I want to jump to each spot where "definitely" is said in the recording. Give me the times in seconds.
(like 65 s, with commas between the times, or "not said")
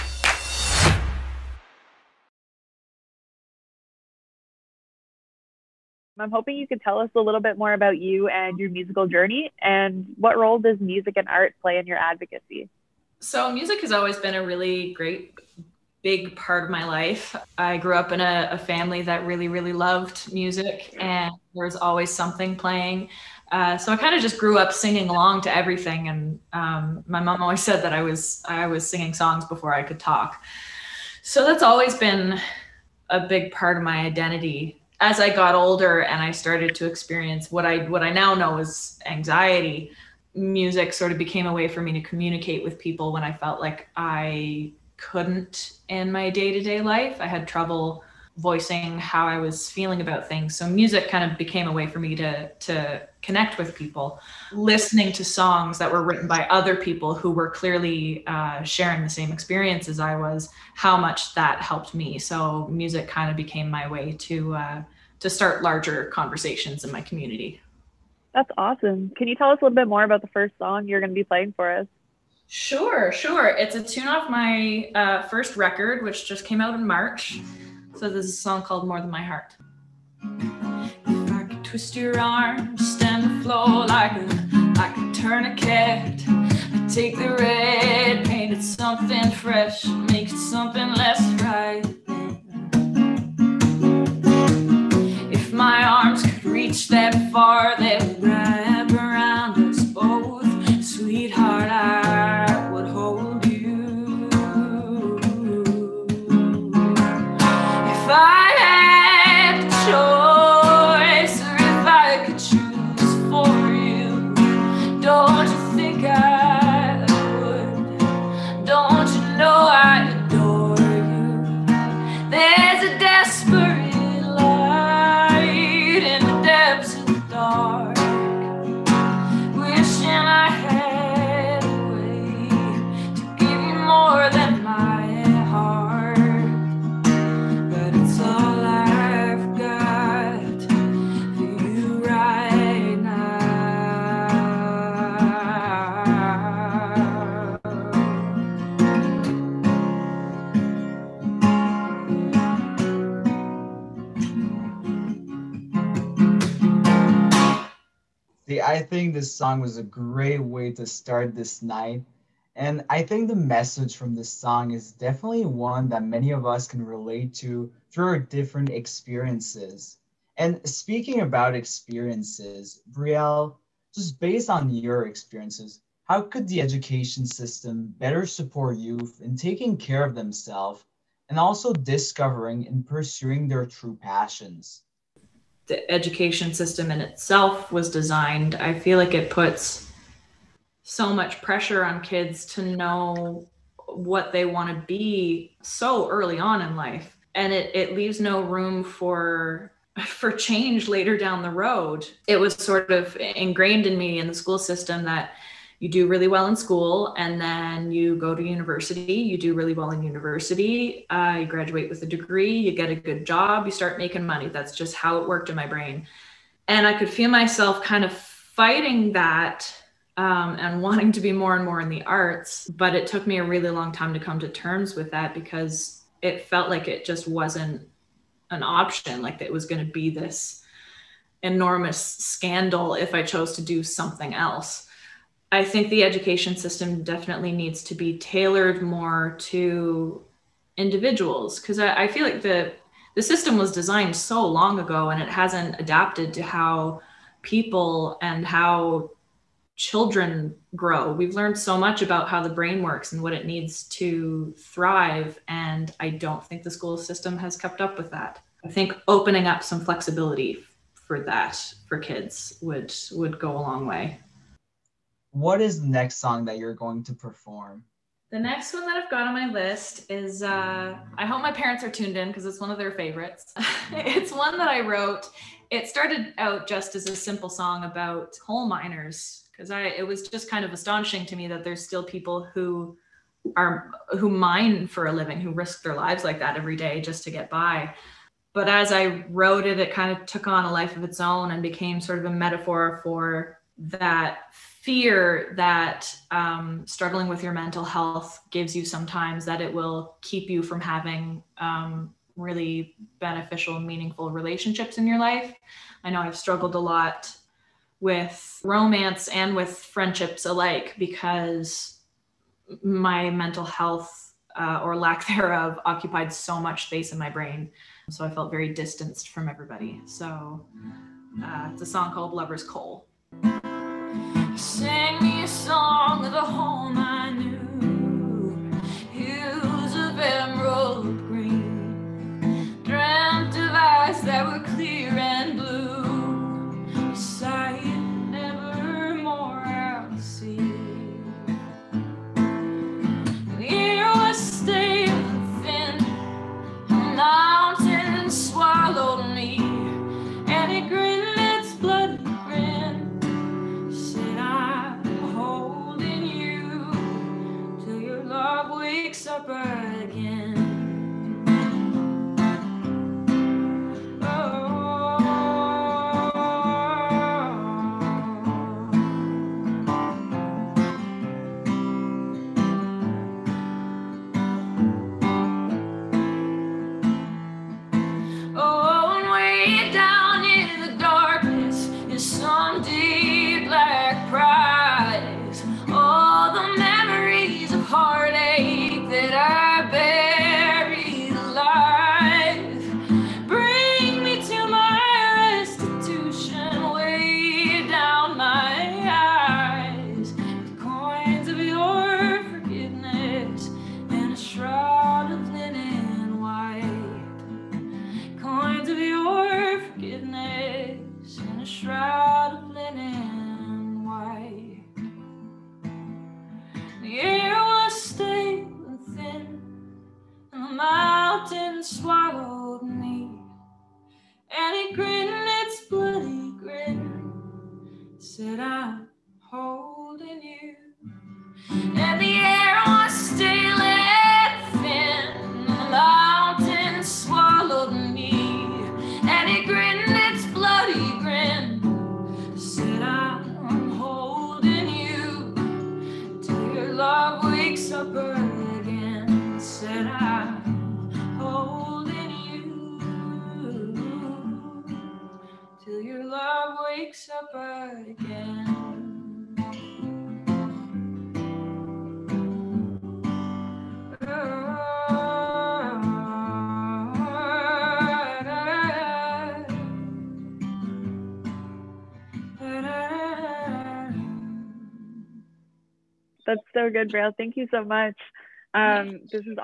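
164 s, 237 s.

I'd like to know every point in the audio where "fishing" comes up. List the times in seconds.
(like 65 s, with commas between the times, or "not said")
not said.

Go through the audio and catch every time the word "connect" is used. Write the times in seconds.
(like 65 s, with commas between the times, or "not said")
53 s.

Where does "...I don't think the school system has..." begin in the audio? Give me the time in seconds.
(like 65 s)
256 s.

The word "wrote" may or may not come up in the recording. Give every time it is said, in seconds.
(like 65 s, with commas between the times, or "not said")
274 s, 289 s.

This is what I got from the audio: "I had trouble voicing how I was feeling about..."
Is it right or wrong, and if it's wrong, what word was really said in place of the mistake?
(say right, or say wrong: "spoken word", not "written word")
right.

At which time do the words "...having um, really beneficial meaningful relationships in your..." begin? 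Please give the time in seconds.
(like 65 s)
300 s.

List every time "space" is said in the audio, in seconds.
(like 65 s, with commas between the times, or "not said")
316 s.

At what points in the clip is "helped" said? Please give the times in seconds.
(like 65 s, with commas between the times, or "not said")
61 s.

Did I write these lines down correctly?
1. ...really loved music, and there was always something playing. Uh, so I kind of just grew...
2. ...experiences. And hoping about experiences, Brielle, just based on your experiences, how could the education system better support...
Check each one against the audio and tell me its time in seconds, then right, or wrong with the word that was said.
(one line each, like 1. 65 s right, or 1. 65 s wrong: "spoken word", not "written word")
1. 19 s right
2. 168 s wrong: "speaking", not "hoping".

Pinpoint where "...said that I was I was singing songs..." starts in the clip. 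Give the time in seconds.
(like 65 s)
27 s.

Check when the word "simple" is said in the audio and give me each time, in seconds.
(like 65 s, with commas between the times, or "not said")
277 s.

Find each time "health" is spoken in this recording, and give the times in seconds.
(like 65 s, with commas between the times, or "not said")
297 s, 313 s.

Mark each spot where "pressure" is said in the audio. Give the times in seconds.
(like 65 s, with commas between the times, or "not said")
191 s.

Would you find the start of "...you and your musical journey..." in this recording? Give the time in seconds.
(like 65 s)
7 s.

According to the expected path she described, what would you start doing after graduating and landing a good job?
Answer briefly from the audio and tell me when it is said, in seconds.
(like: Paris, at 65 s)
making money, at 213 s.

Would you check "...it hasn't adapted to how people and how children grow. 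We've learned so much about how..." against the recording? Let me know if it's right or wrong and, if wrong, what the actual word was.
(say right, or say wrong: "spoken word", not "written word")
right.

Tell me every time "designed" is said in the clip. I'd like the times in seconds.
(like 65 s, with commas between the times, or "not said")
187 s, 243 s.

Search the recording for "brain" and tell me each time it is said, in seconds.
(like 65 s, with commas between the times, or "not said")
215 s, 252 s, 317 s.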